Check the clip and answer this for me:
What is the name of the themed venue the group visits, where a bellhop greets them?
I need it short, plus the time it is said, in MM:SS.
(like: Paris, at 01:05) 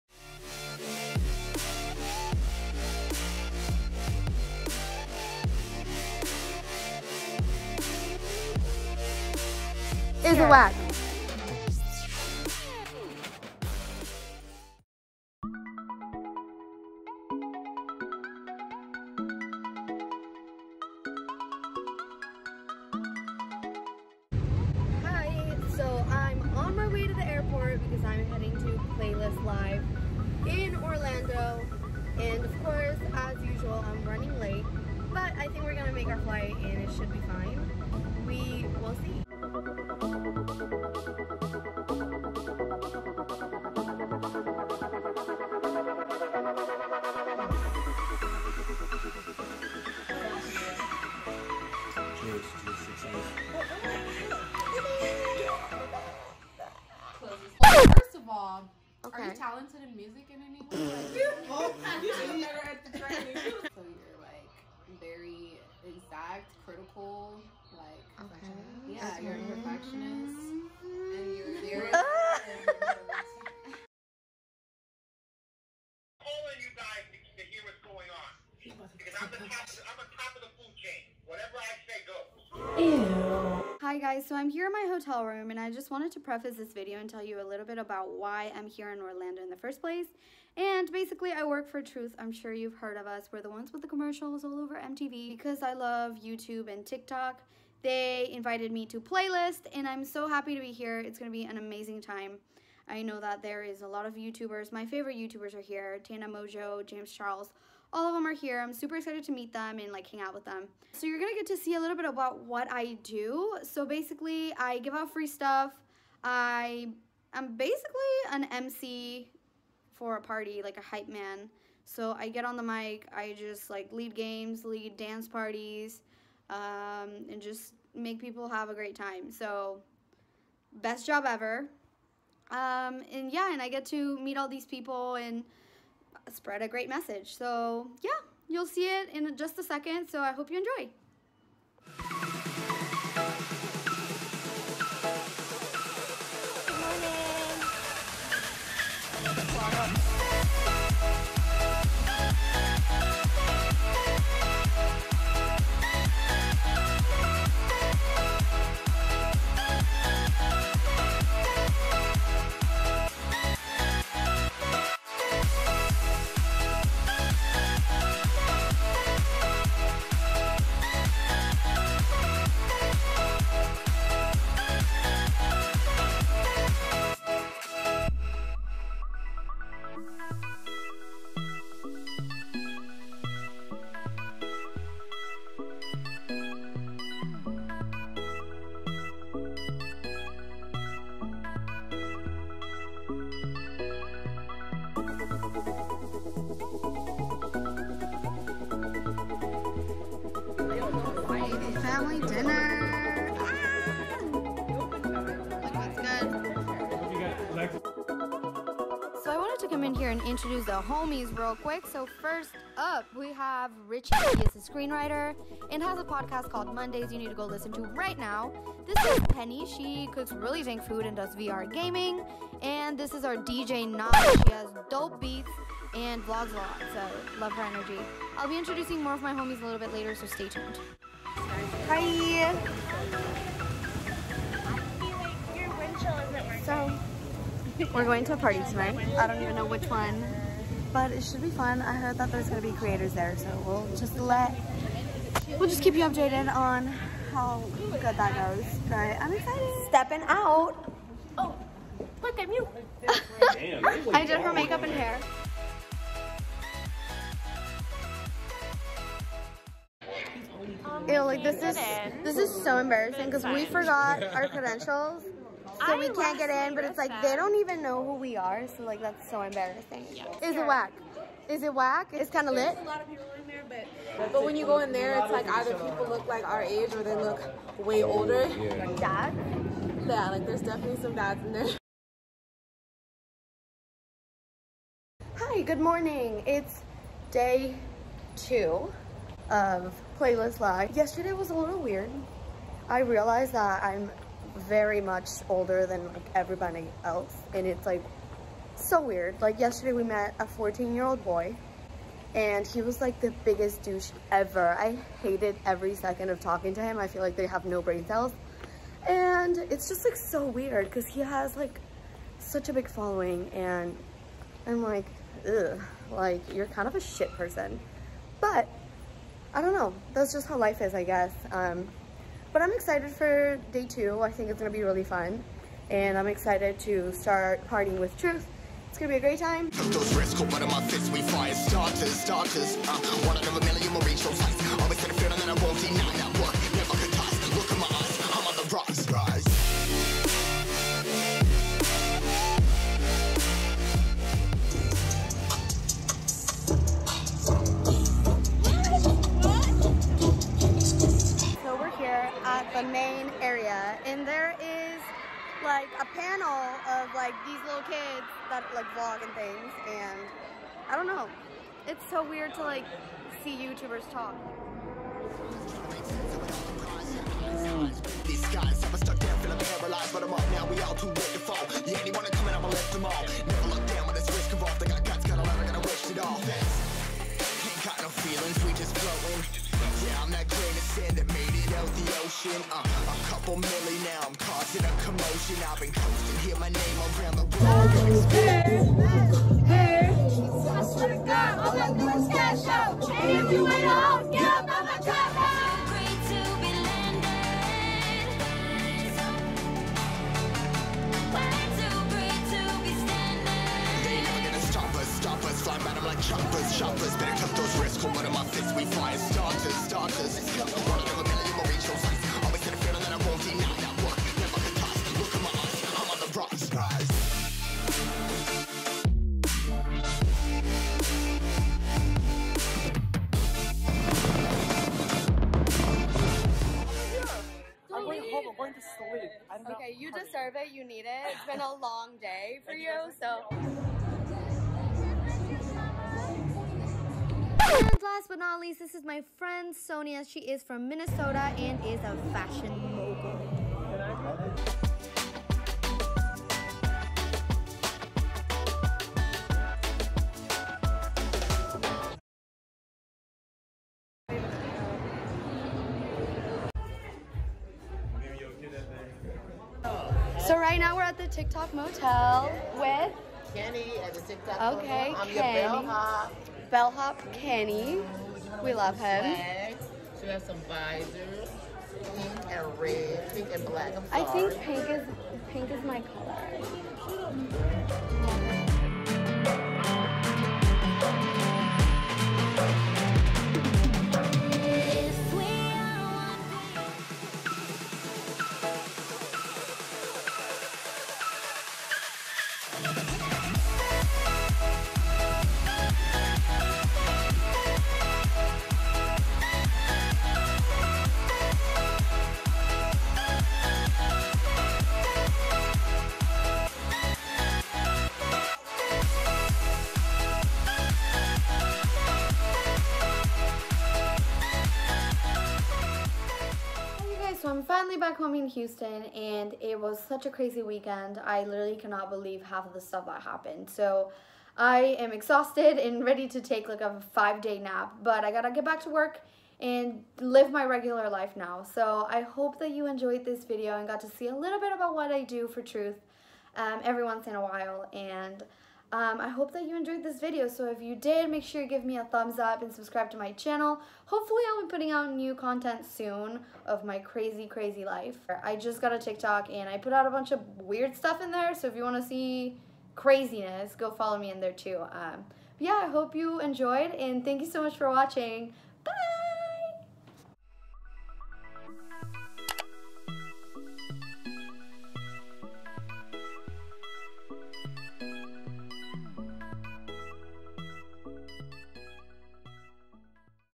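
TikTok Motel, at 07:41.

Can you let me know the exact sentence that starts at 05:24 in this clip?
I think it's gonna be really fun.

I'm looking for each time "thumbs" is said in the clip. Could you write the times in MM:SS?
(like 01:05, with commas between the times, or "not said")
09:02.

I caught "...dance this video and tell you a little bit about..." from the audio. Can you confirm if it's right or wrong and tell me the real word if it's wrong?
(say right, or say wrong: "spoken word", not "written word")
wrong: "preface", not "dance".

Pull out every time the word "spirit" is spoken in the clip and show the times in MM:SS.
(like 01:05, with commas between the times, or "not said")
not said.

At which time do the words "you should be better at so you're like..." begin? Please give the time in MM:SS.
01:02.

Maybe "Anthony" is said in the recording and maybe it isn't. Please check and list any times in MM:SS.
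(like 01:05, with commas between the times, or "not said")
not said.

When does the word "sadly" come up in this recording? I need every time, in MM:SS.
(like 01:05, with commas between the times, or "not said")
not said.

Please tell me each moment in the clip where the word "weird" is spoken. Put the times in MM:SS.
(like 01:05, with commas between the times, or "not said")
04:51, 04:59, 05:10, 06:02, 09:10.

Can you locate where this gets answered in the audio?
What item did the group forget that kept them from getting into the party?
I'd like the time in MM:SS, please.
04:24.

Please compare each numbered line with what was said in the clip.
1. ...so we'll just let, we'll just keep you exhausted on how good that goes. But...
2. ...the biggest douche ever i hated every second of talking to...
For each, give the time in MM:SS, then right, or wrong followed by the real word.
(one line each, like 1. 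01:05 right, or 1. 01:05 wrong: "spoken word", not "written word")
1. 04:03 wrong: "updated", not "exhausted"
2. 05:03 right.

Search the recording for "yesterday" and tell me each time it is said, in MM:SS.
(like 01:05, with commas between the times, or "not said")
04:50, 04:59.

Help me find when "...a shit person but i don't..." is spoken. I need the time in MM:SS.
05:16.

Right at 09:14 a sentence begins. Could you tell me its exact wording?
Um, yeah, I hope you enjoyed and thank you so much for watching.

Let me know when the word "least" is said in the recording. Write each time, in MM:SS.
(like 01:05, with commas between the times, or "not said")
07:18.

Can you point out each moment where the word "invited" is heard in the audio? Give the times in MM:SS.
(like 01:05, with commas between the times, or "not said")
01:38.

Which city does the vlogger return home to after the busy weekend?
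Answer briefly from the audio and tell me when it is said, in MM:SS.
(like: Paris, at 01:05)
Houston, at 08:38.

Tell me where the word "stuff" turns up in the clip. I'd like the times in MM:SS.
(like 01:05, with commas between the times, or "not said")
01:55, 08:42, 09:10.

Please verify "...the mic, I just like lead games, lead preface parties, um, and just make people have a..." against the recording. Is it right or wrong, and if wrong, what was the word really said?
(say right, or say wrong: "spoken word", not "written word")
wrong: "dance", not "preface".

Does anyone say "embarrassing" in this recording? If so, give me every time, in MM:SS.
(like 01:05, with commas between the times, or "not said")
04:22, 04:29.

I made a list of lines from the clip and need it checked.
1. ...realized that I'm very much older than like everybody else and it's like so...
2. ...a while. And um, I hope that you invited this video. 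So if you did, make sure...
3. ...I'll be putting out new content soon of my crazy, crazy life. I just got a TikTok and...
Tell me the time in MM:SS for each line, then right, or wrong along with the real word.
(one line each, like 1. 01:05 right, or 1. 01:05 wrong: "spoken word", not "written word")
1. 04:52 right
2. 08:57 wrong: "enjoyed", not "invited"
3. 09:04 right.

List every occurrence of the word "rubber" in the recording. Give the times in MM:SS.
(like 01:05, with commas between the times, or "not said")
not said.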